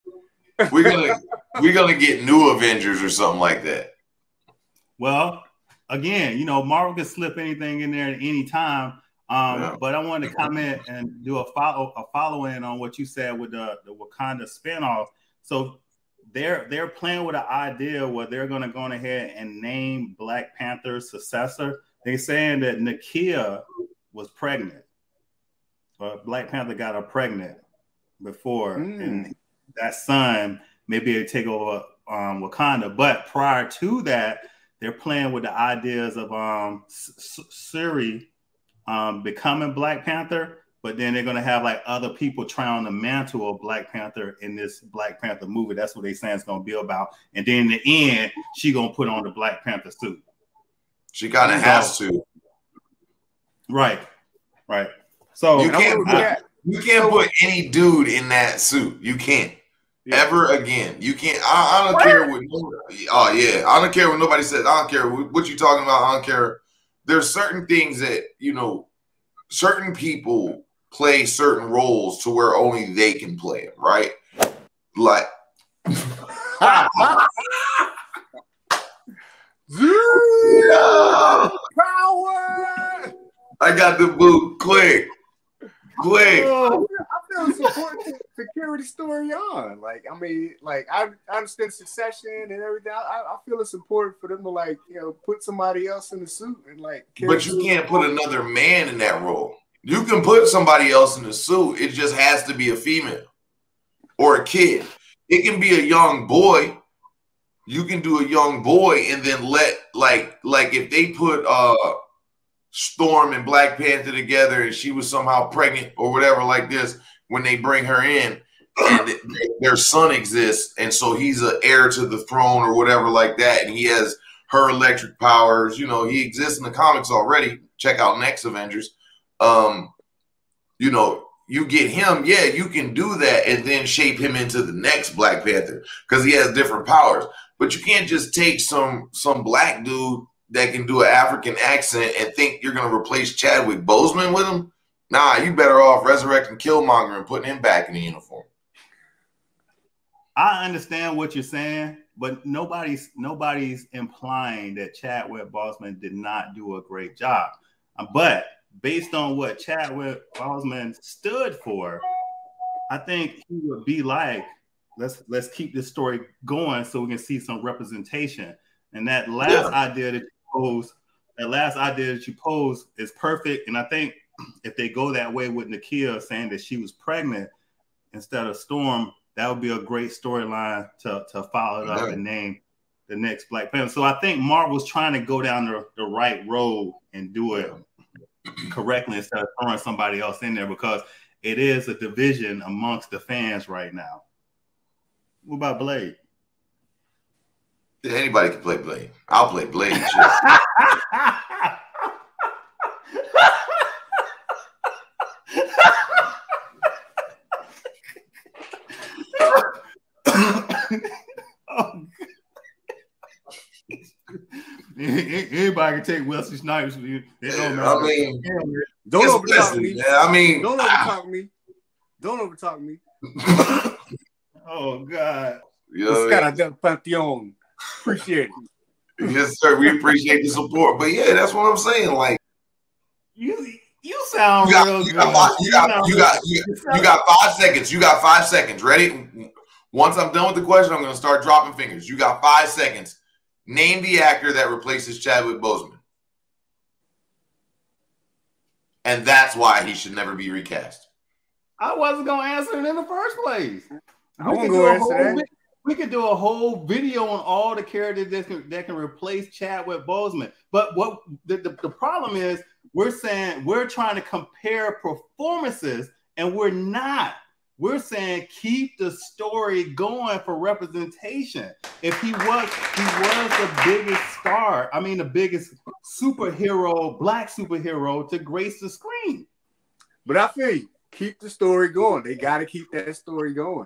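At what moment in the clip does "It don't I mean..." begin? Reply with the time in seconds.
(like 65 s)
216 s.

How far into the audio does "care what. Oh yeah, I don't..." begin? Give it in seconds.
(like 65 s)
62 s.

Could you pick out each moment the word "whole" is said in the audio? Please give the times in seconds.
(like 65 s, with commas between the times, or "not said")
256 s.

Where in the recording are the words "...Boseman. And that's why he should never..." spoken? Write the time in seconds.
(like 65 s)
245 s.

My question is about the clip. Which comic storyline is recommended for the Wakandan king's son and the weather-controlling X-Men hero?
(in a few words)
Next Avengers.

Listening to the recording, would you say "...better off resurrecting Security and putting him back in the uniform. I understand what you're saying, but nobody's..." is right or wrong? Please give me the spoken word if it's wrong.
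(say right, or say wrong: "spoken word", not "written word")
wrong: "Killmonger", not "Security".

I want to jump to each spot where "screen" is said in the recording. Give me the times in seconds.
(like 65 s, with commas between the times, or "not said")
278 s.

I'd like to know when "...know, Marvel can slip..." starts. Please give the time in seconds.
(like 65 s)
6 s.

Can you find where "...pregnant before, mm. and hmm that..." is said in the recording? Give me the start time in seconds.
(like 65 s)
27 s.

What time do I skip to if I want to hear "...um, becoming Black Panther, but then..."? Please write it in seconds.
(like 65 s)
38 s.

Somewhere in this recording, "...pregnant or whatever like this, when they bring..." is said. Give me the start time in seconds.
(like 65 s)
115 s.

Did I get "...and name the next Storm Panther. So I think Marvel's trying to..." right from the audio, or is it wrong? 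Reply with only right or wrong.
wrong.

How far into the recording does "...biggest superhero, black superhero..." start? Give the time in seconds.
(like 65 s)
275 s.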